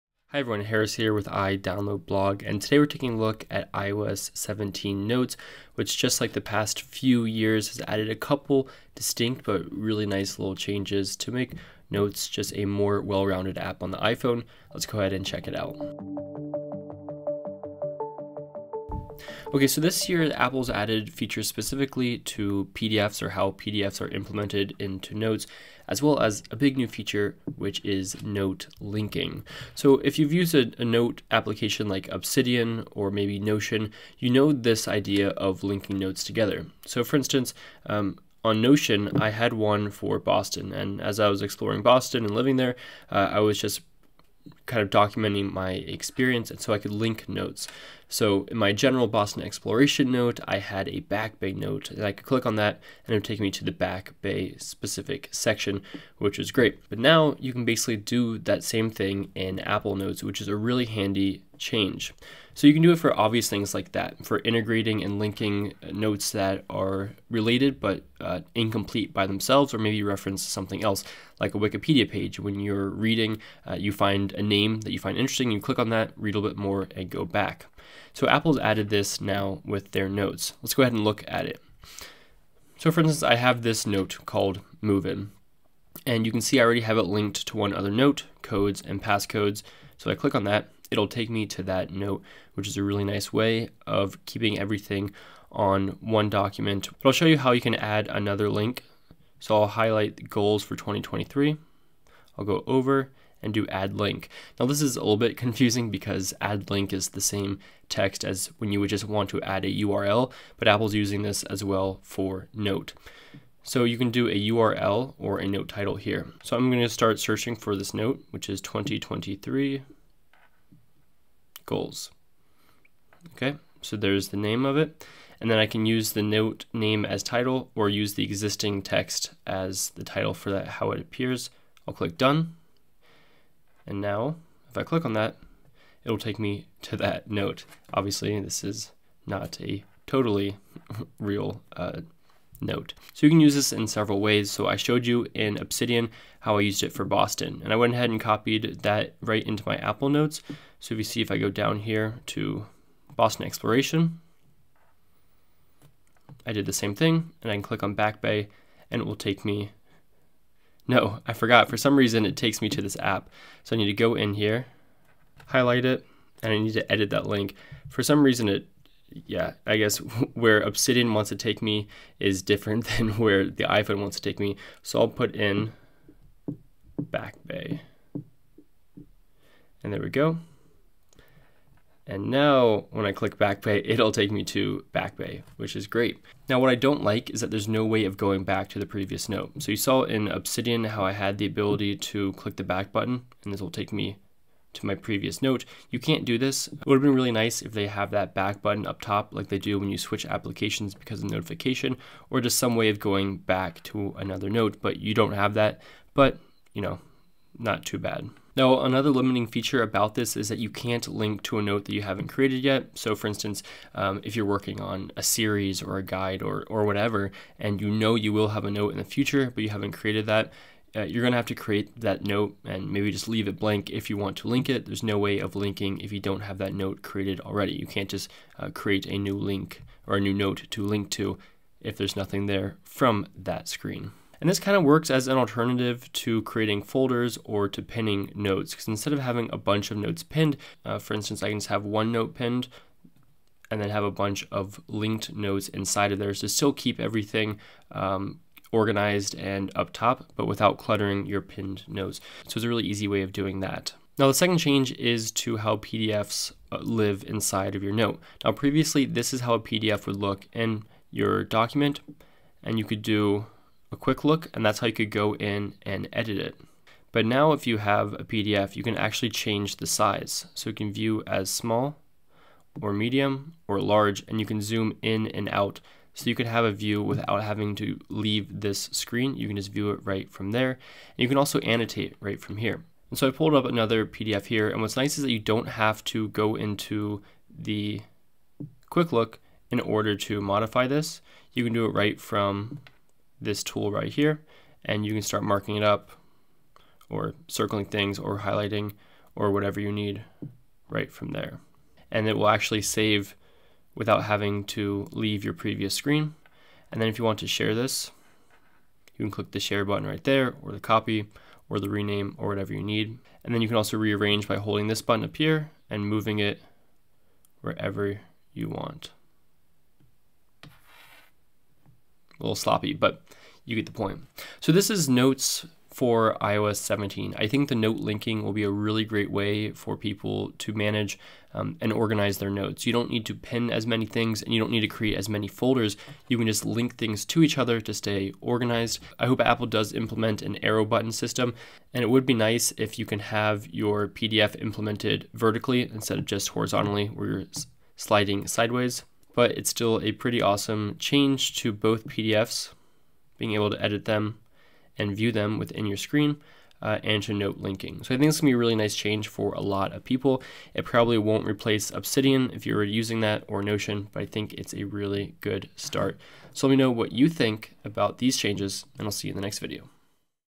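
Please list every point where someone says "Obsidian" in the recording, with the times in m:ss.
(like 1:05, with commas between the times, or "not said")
0:32, 2:25, 2:50, 3:10, 6:01.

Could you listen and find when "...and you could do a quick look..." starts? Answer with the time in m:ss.
4:22.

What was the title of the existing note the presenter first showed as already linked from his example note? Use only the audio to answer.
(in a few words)
codes and passcodes.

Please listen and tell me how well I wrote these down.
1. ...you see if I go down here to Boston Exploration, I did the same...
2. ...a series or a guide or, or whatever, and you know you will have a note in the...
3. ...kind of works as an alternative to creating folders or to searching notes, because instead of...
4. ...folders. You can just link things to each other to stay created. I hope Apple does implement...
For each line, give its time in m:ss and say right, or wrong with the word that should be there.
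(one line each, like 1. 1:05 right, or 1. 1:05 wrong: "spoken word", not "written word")
1. 2:30 right
2. 3:35 right
3. 3:54 wrong: "pinning", not "searching"
4. 5:35 wrong: "organized", not "created".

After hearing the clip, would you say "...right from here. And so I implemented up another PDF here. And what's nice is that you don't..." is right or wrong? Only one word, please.
wrong.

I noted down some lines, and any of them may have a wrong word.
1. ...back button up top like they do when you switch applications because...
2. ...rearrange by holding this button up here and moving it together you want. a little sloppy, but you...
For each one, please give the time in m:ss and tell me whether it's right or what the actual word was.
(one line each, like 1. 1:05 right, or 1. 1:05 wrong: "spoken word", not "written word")
1. 3:18 right
2. 5:13 wrong: "wherever", not "together".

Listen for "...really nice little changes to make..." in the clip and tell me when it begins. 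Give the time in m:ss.
0:09.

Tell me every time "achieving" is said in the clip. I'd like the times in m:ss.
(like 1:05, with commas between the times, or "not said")
not said.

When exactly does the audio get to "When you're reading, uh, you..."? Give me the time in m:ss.
1:12.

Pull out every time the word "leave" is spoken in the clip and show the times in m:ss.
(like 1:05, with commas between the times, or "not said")
3:43, 4:38, 5:05.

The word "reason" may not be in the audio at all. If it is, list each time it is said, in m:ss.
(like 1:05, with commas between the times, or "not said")
2:41, 2:48.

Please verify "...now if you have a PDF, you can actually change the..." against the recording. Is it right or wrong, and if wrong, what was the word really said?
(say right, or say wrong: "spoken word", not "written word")
right.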